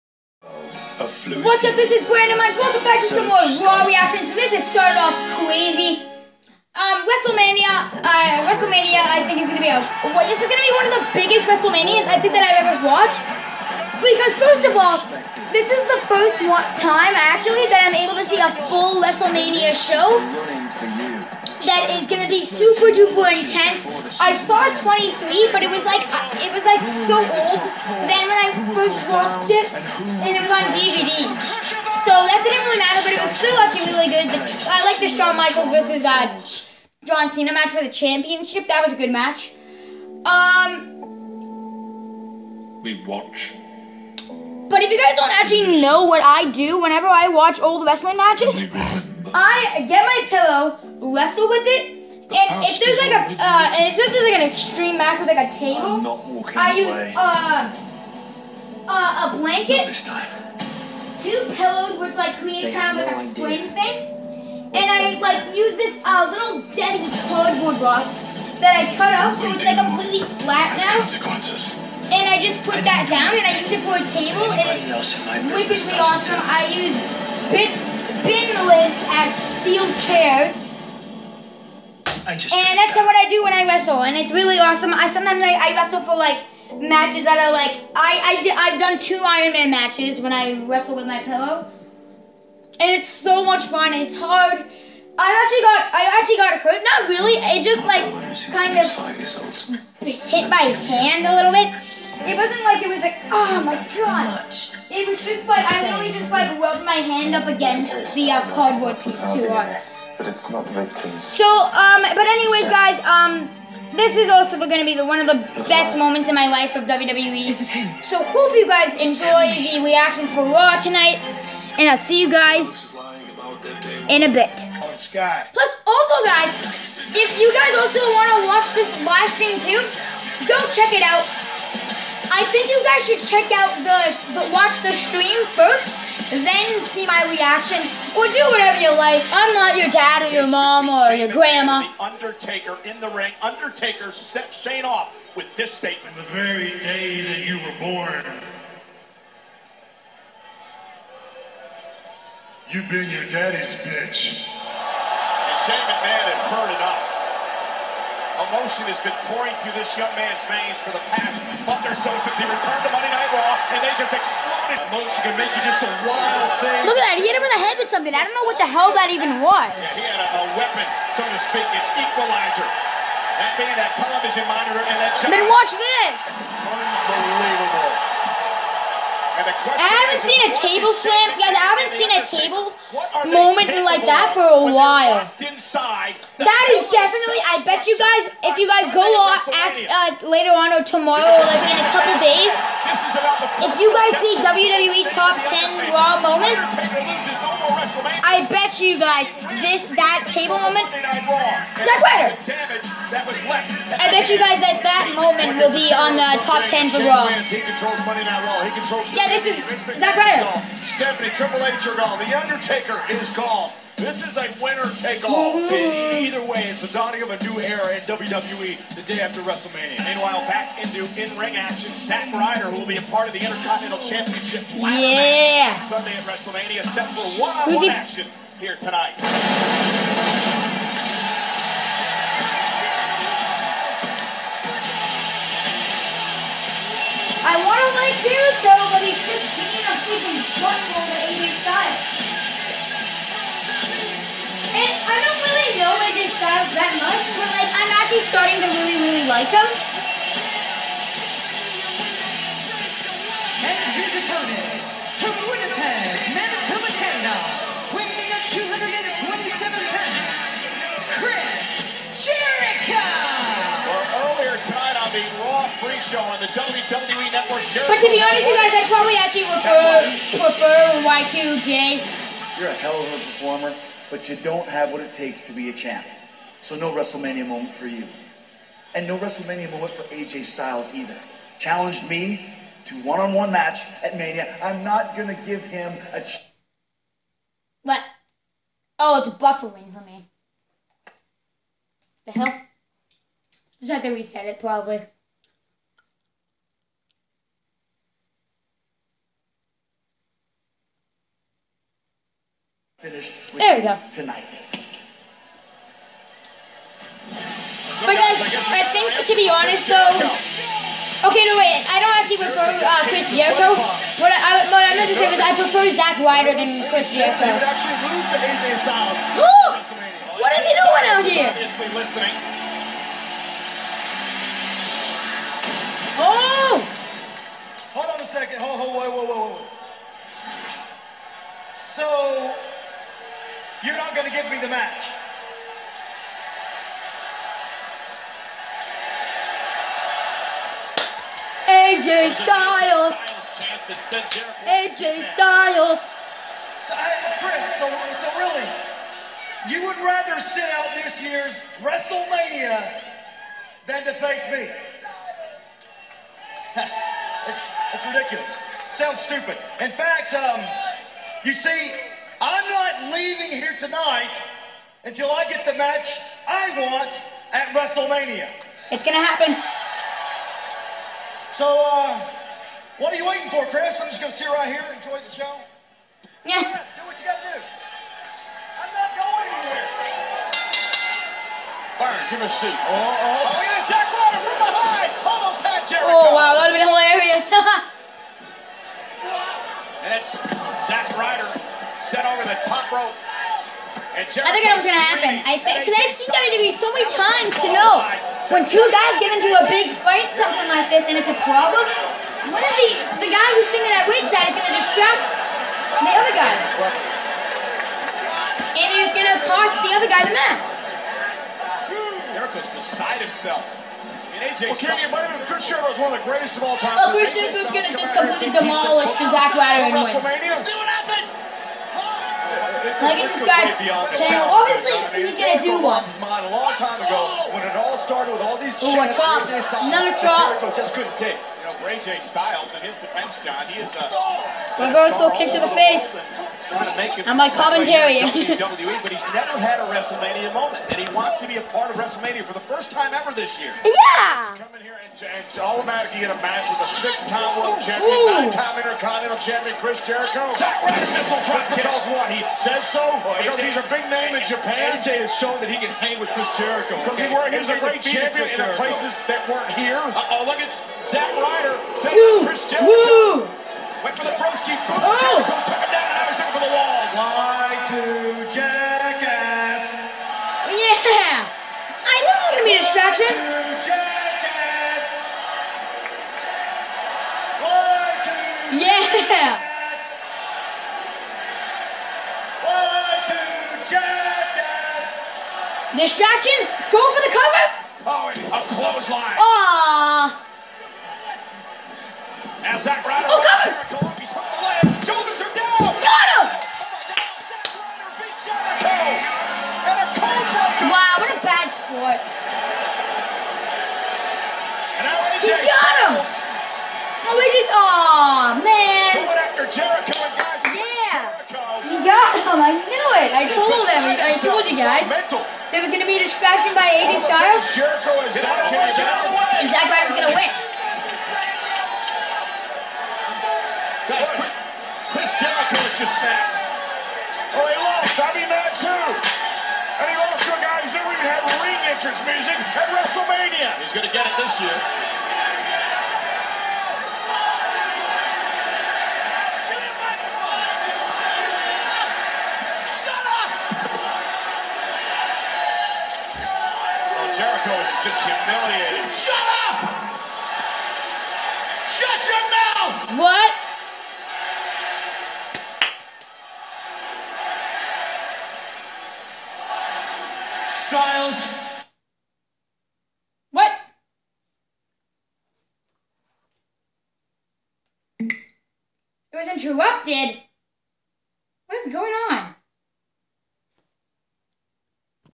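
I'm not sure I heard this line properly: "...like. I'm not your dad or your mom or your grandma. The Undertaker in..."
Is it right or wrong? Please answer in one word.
right.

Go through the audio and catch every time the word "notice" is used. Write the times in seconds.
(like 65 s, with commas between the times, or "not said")
not said.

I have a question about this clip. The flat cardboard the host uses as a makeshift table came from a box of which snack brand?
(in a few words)
Little Debbie.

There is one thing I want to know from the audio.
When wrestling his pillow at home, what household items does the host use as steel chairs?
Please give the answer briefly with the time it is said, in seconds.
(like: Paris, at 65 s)
Bin lids, at 77 s.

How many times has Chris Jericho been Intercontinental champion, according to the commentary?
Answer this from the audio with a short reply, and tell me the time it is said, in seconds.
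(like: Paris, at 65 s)
9, at 448 s.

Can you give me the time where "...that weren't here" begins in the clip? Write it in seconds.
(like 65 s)
459 s.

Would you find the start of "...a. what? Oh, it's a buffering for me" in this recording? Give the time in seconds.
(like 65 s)
286 s.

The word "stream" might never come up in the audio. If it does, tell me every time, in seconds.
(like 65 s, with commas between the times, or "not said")
129 s, 134 s.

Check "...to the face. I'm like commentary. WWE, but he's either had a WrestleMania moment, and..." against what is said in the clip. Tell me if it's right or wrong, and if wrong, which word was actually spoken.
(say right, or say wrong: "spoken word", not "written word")
wrong: "never", not "either".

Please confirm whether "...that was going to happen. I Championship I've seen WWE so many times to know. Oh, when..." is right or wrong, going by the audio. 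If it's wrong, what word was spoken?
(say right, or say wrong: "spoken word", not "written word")
wrong: "Because", not "Championship".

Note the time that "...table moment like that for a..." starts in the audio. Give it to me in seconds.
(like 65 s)
182 s.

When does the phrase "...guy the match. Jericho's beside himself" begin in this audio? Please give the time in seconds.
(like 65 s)
410 s.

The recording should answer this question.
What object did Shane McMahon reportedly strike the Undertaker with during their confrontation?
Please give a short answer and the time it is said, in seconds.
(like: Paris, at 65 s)
Television monitor, at 173 s.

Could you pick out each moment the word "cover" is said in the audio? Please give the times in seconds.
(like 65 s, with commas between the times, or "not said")
487 s, 493 s.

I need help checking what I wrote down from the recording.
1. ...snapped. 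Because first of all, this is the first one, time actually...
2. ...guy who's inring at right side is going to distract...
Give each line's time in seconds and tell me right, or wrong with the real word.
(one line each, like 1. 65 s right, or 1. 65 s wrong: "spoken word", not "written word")
1. 12 s wrong: "watched", not "snapped"
2. 403 s wrong: "standing", not "inring".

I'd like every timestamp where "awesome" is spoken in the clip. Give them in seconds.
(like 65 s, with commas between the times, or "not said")
75 s, 84 s.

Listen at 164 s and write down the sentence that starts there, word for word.
Motion can make you just a wild thing.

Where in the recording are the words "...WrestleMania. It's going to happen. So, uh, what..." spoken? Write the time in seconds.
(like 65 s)
367 s.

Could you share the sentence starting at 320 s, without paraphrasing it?
what is he doing out here?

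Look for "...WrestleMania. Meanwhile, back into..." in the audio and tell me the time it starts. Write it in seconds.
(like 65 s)
219 s.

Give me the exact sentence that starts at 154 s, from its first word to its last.
And Shane McMahon had heard enough.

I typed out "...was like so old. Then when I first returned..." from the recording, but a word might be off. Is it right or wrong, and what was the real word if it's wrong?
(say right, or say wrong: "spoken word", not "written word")
wrong: "watched", not "returned".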